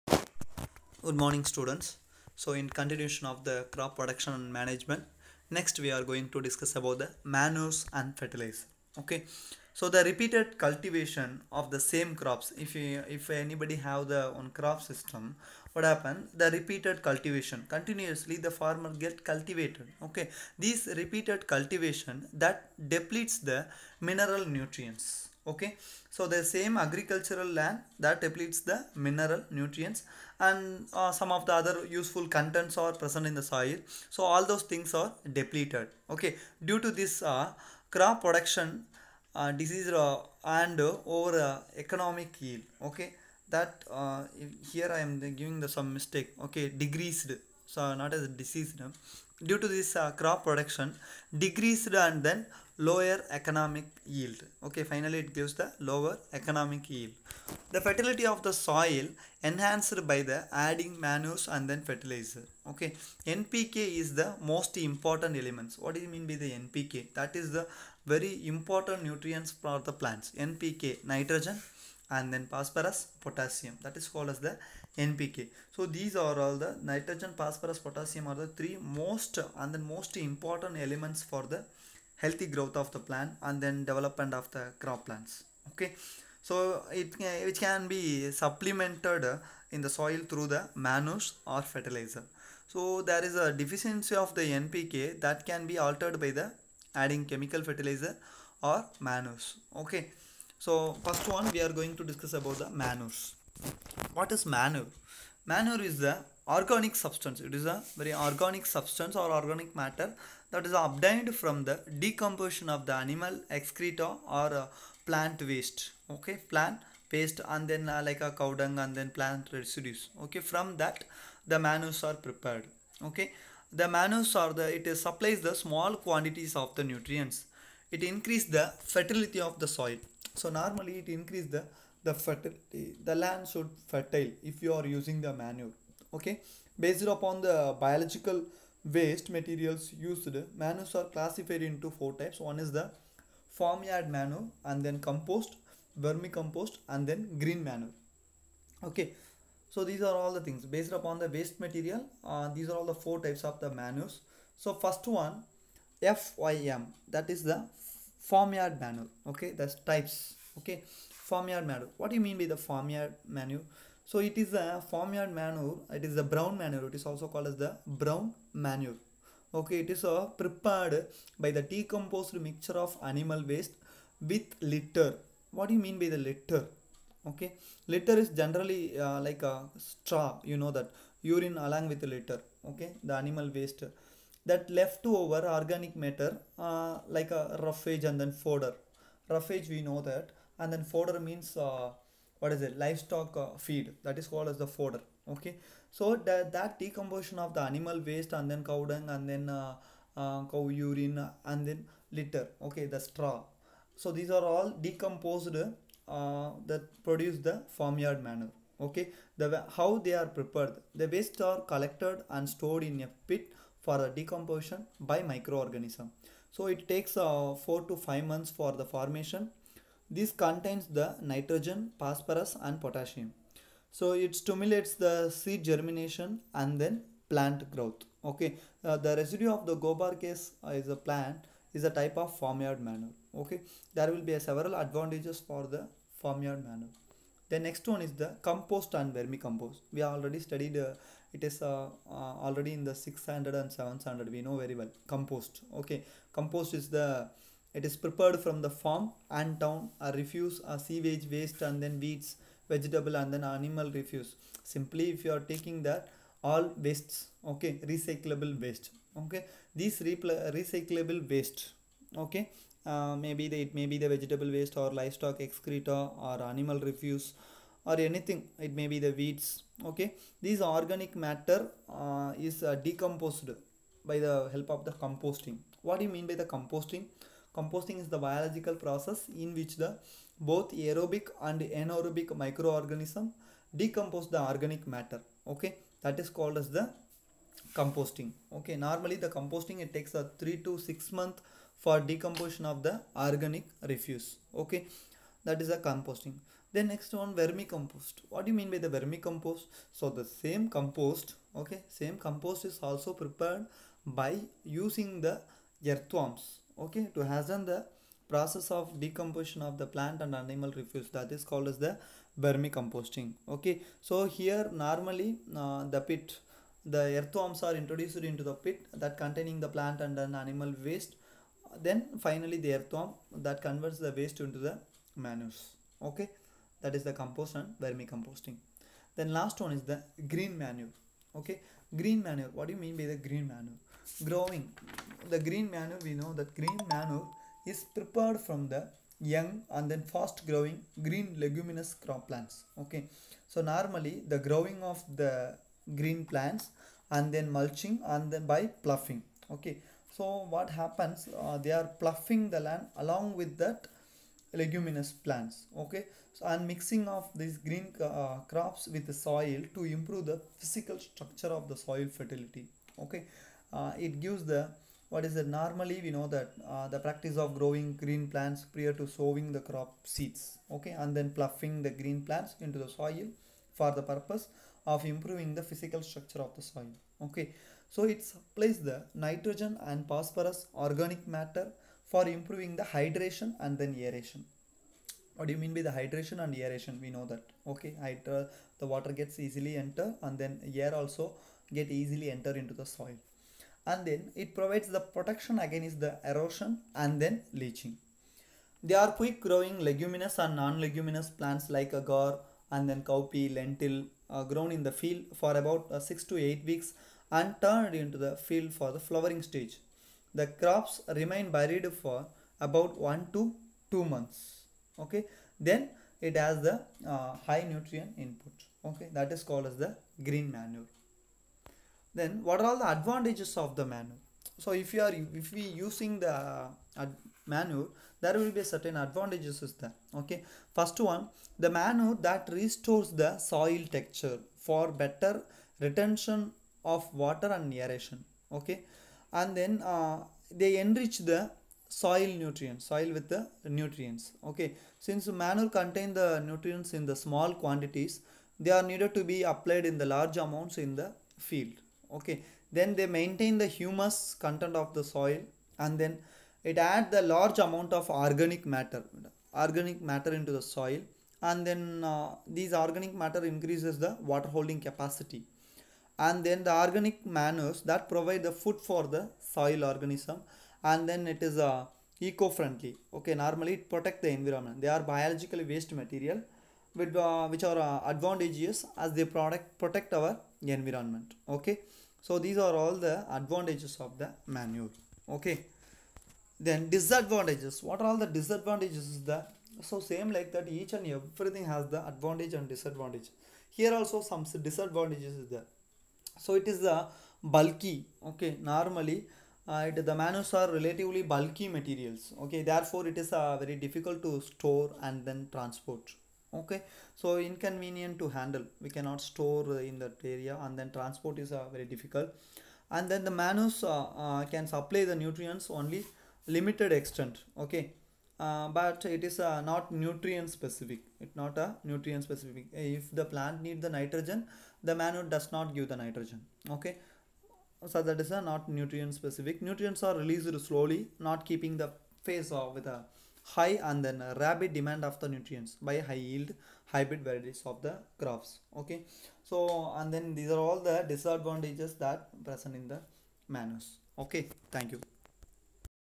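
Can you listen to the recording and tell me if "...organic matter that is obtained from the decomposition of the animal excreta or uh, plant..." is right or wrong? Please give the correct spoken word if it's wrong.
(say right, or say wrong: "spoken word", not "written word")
right.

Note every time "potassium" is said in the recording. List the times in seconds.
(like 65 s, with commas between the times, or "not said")
73 s, 77 s, 222 s.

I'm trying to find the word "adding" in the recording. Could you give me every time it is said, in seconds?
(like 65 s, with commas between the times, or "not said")
60 s, 96 s.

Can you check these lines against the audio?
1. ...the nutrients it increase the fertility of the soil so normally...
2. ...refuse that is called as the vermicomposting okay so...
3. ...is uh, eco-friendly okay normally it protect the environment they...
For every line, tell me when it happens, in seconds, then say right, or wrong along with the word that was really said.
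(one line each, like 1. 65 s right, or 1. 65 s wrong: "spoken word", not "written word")
1. 126 s right
2. 310 s right
3. 471 s right.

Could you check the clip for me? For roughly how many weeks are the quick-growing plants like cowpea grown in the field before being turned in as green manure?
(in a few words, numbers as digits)
6 to 8 weeks.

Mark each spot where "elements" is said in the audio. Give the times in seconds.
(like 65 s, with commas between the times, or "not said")
65 s, 80 s.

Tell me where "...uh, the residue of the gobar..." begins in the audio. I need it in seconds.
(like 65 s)
228 s.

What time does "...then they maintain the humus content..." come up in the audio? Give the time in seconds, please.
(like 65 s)
452 s.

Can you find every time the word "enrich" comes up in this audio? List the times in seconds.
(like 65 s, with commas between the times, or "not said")
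440 s.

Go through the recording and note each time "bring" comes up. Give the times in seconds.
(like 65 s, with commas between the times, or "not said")
not said.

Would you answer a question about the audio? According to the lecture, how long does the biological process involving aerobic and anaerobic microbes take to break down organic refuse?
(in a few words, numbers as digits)
3 to 6 months.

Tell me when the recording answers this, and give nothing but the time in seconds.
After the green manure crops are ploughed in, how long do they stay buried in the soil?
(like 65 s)
413 s.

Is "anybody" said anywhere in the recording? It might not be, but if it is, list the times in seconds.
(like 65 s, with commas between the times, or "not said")
13 s.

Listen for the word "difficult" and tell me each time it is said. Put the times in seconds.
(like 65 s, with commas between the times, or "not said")
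503 s, 511 s.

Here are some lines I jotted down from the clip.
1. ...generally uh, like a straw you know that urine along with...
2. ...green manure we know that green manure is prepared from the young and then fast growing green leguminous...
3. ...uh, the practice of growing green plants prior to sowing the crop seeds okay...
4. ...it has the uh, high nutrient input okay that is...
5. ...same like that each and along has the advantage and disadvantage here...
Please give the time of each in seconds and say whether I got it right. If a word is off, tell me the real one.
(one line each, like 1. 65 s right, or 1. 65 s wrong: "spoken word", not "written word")
1. 178 s right
2. 335 s right
3. 366 s right
4. 416 s right
5. 489 s wrong: "everything", not "along".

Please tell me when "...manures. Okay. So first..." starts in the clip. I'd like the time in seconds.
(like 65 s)
98 s.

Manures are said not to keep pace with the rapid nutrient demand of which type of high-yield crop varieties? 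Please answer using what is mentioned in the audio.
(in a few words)
hybrid varieties.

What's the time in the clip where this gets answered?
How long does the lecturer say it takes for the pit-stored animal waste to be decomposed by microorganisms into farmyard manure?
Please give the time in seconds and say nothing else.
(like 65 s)
217 s.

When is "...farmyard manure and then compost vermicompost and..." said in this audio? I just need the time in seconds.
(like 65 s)
143 s.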